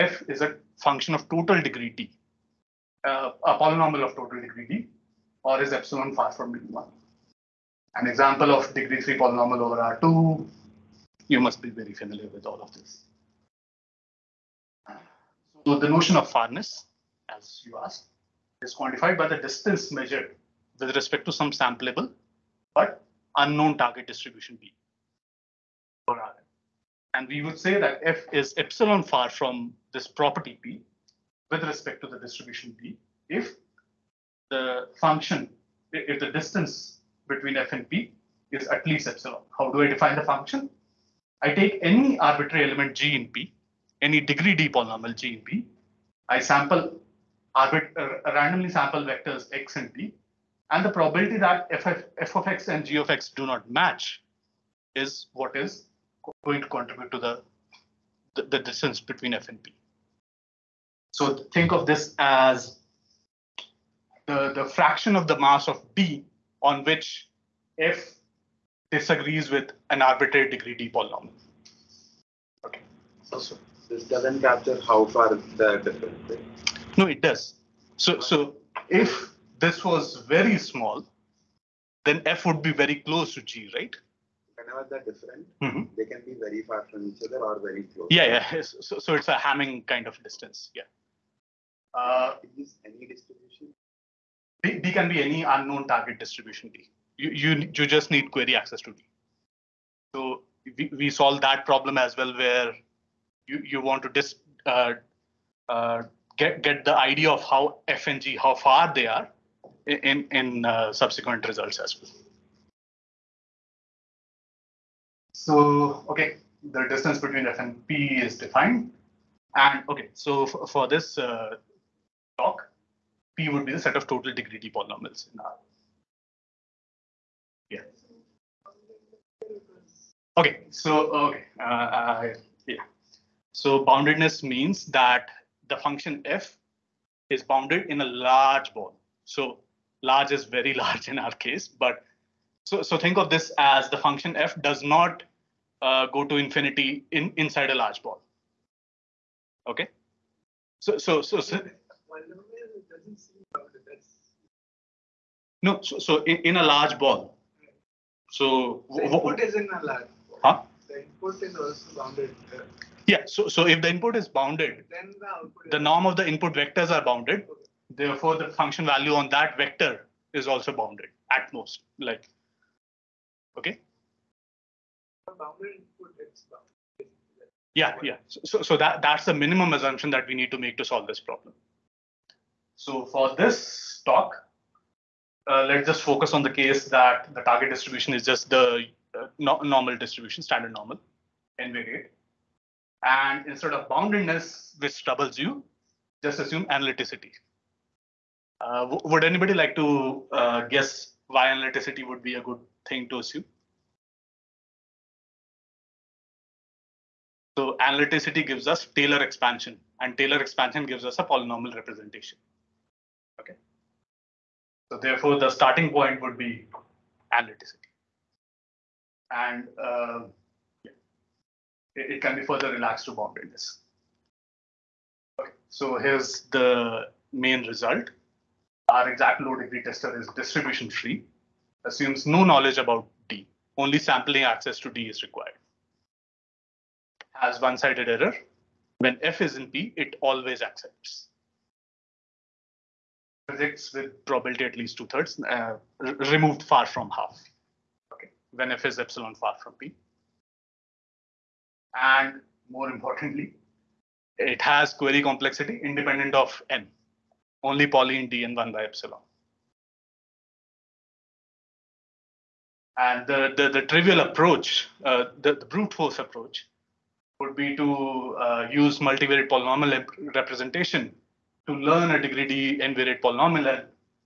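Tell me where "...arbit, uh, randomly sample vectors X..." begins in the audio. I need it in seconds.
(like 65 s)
47 s.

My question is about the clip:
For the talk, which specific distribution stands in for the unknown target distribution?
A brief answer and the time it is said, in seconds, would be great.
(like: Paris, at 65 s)
Standard normal, at 190 s.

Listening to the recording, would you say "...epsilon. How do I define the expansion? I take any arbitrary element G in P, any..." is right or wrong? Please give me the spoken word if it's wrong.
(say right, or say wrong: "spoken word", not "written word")
wrong: "function", not "expansion".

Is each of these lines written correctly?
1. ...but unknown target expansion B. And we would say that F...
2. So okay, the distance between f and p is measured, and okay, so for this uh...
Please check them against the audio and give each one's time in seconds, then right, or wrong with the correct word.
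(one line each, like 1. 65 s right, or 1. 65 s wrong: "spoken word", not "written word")
1. 22 s wrong: "distribution", not "expansion"
2. 115 s wrong: "defined", not "measured".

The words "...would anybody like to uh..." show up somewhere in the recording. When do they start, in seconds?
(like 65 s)
199 s.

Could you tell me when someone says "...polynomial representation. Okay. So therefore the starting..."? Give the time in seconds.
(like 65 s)
211 s.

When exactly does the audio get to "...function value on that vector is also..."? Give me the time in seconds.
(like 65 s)
168 s.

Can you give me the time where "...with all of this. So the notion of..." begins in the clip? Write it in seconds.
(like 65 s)
12 s.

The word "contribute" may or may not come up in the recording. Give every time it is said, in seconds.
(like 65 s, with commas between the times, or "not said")
56 s.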